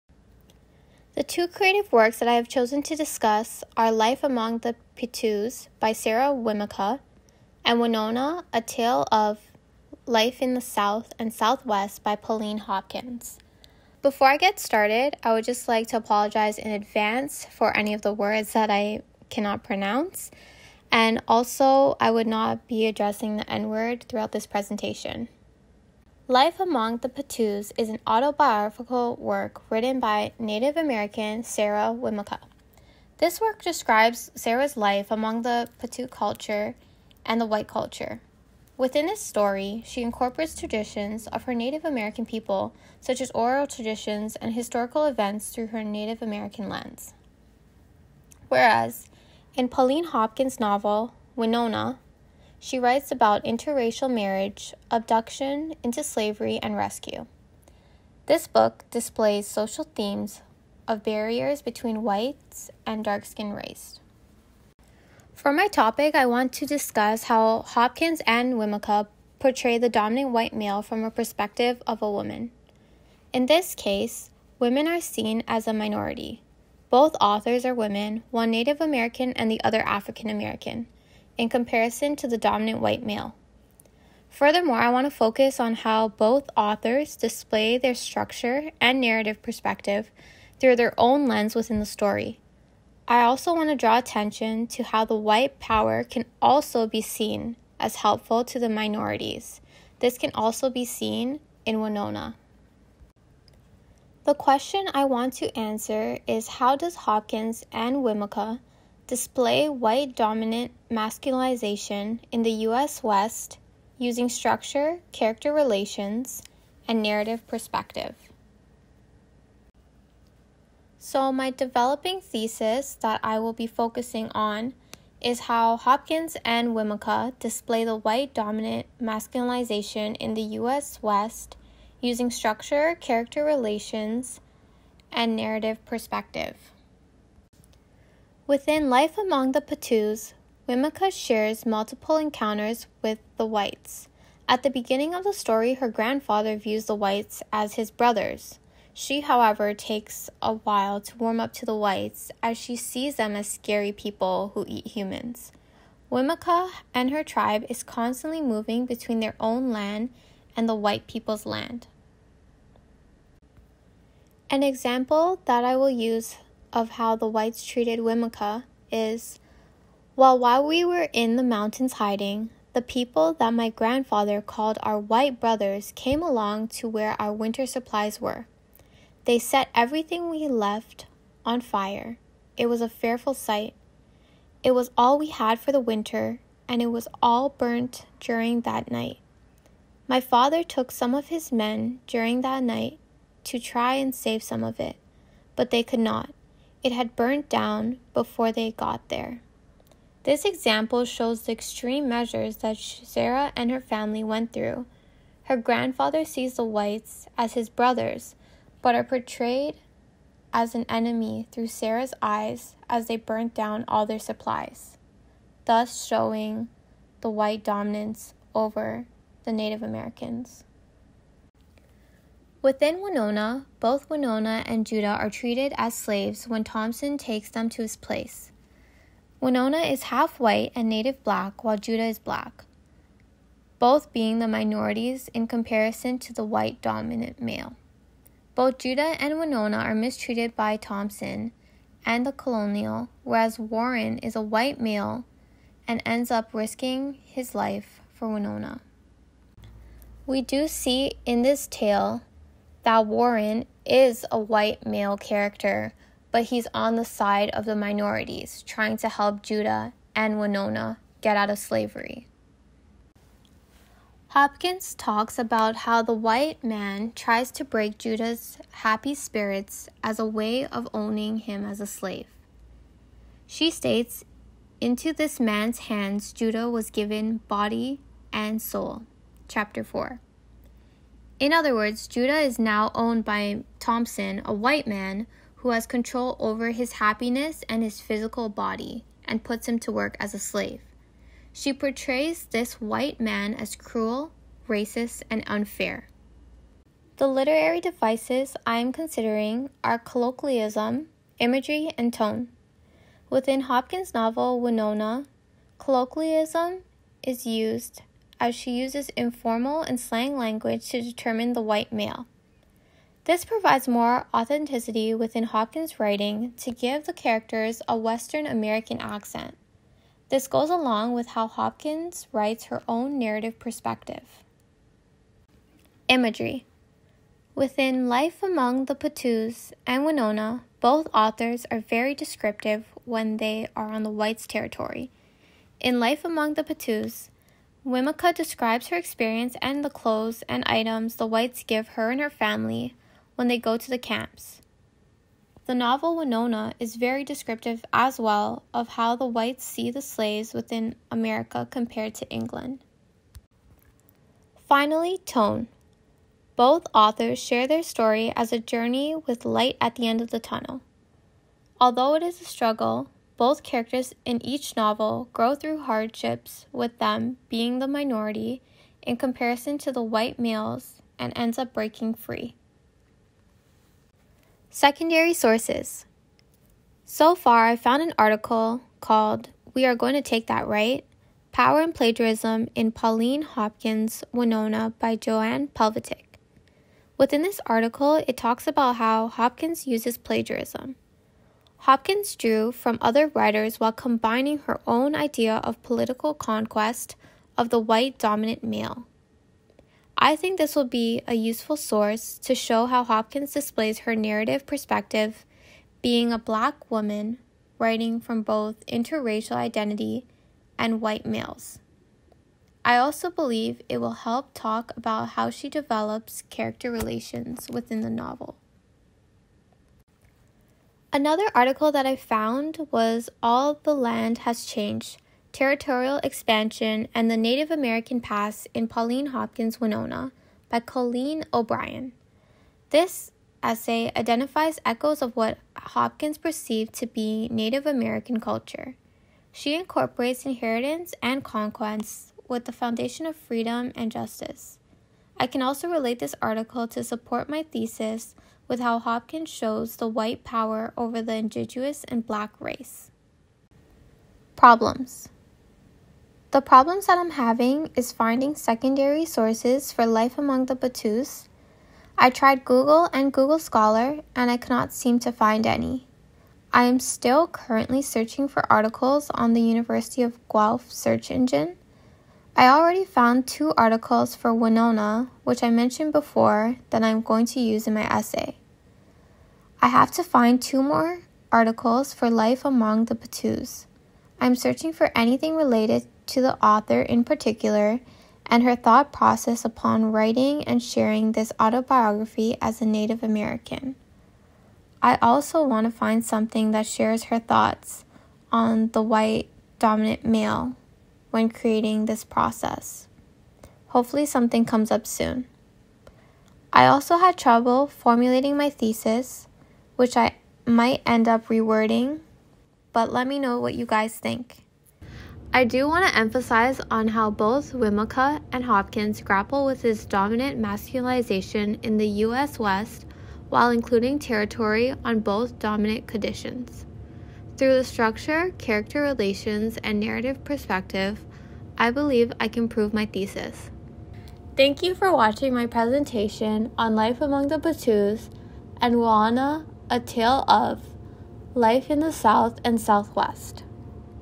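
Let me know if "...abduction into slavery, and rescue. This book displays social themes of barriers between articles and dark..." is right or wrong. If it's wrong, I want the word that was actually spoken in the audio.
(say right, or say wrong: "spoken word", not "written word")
wrong: "whites", not "articles".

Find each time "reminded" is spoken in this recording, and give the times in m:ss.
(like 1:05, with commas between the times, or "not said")
not said.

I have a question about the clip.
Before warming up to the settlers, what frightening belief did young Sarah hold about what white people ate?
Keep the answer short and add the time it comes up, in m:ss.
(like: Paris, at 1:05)
Humans, at 2:34.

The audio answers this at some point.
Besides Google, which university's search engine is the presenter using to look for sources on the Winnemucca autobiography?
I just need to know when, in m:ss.
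7:49.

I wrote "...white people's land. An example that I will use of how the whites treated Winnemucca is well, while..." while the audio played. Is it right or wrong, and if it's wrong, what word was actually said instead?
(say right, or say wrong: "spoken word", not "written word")
right.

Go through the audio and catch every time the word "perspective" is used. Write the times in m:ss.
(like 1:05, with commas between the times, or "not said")
1:11, 1:29, 1:57, 2:15, 5:23, 6:44, 8:50.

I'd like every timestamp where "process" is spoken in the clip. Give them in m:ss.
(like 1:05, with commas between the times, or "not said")
8:09, 8:22.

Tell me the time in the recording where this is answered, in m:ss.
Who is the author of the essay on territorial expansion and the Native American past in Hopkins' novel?
7:10.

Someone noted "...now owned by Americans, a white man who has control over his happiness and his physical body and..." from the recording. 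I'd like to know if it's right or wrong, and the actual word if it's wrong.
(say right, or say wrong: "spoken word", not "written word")
wrong: "Thompson", not "Americans".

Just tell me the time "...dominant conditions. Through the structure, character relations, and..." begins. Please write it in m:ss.
8:45.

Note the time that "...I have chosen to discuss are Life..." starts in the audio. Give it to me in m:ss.
0:02.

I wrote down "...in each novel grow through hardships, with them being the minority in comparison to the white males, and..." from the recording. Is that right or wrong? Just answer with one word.
right.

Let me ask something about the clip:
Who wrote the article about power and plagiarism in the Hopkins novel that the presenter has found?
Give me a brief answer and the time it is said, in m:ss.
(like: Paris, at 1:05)
Joanne Pavletich, at 6:25.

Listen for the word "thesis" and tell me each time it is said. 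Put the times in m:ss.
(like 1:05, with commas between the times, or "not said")
2:02, 7:27, 8:28, 8:53.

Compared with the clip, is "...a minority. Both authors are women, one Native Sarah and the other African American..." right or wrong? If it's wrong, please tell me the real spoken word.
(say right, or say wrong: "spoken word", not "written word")
wrong: "American", not "Sarah".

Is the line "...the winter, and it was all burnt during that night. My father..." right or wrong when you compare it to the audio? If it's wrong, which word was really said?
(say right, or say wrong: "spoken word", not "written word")
right.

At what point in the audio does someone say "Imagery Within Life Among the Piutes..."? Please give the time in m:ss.
5:26.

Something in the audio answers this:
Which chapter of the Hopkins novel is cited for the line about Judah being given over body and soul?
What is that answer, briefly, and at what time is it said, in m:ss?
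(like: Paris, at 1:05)
4, at 4:39.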